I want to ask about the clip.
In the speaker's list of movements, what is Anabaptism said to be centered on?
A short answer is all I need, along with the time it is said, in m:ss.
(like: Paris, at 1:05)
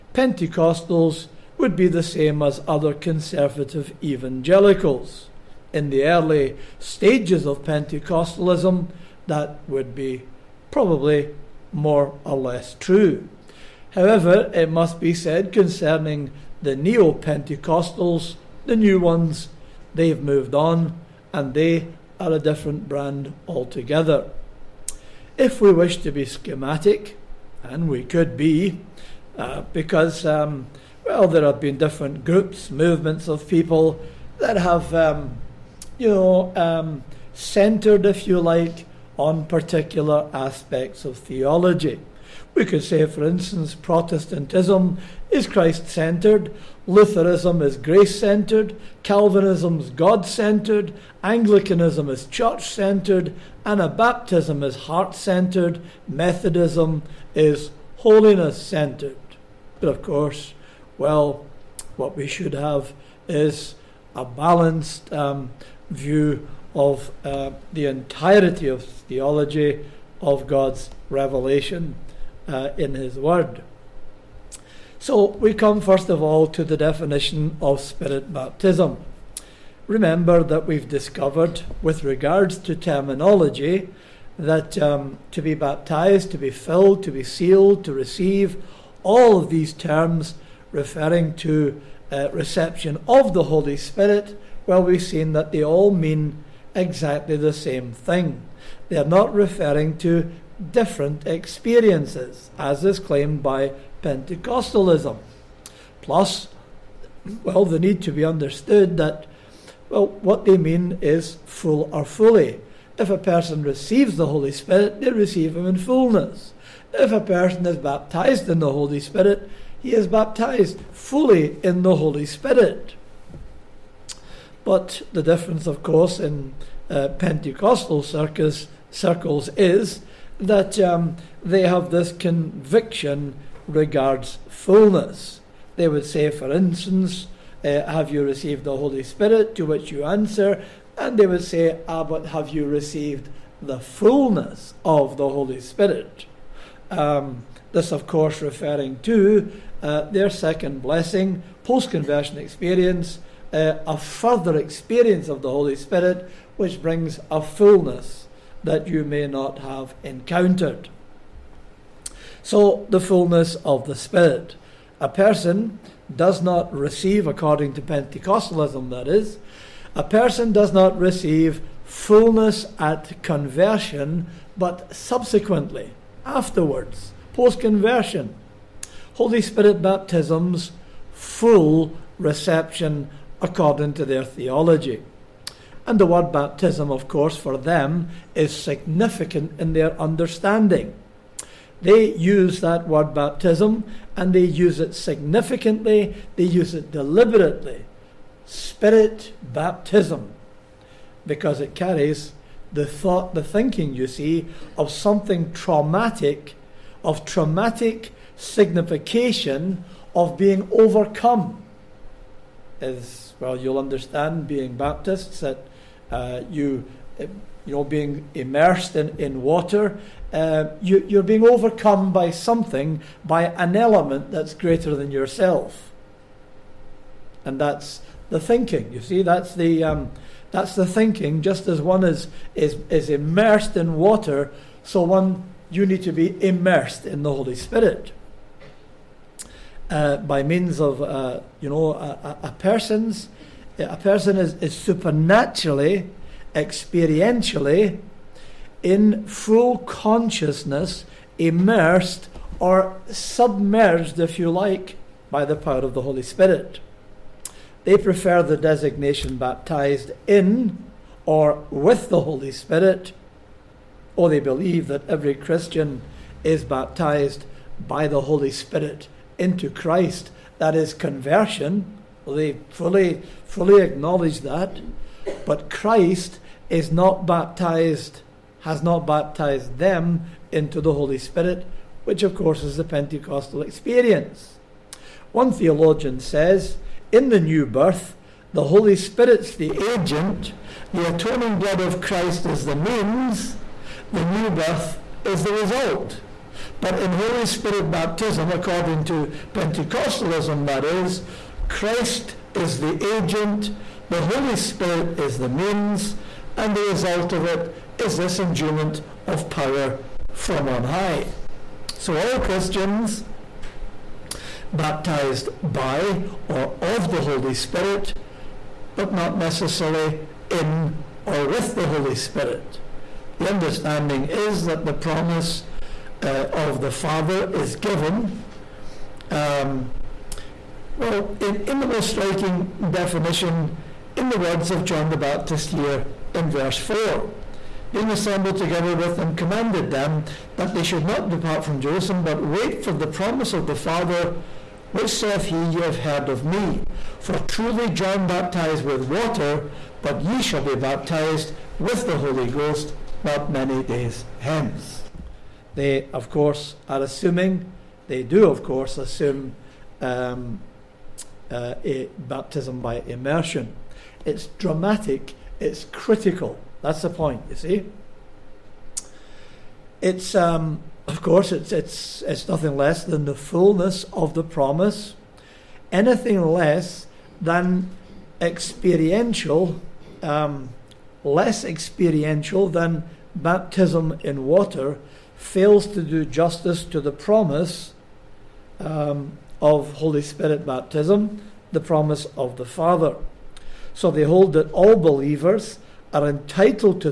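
Heart, at 0:53.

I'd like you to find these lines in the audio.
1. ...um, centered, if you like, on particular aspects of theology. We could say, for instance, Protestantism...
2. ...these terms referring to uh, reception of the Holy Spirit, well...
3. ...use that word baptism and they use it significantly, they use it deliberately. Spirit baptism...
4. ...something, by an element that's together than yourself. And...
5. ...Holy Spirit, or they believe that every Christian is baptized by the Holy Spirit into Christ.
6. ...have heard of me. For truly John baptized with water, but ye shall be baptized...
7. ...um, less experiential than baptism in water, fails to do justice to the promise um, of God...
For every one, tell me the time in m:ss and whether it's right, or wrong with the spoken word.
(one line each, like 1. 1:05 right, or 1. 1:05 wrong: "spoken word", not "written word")
1. 0:36 right
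2. 1:29 right
3. 3:12 right
4. 3:42 wrong: "greater", not "together"
5. 4:22 right
6. 5:45 right
7. 6:20 wrong: "Holy", not "God".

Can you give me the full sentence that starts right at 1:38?
They are not referring to different experiences, as is claimed by Pentecostalism.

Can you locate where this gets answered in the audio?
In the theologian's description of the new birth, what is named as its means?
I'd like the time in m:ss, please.
4:50.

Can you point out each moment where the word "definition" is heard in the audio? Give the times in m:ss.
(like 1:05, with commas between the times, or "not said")
1:16, 5:32.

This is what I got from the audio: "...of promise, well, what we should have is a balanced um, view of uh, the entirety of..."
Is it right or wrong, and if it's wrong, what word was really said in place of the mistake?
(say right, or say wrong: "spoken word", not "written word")
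wrong: "course", not "promise".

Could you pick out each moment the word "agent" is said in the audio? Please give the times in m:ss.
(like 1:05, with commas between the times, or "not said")
4:49, 5:03.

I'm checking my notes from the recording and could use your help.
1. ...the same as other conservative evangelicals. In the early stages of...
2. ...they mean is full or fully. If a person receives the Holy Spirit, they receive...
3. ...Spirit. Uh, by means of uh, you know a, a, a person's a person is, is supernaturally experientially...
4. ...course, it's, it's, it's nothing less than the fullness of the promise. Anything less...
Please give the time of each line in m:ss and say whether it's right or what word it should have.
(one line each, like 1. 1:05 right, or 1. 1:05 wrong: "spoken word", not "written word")
1. 0:01 right
2. 1:50 right
3. 3:57 right
4. 6:11 right.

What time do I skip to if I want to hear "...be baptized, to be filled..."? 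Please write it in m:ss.
1:25.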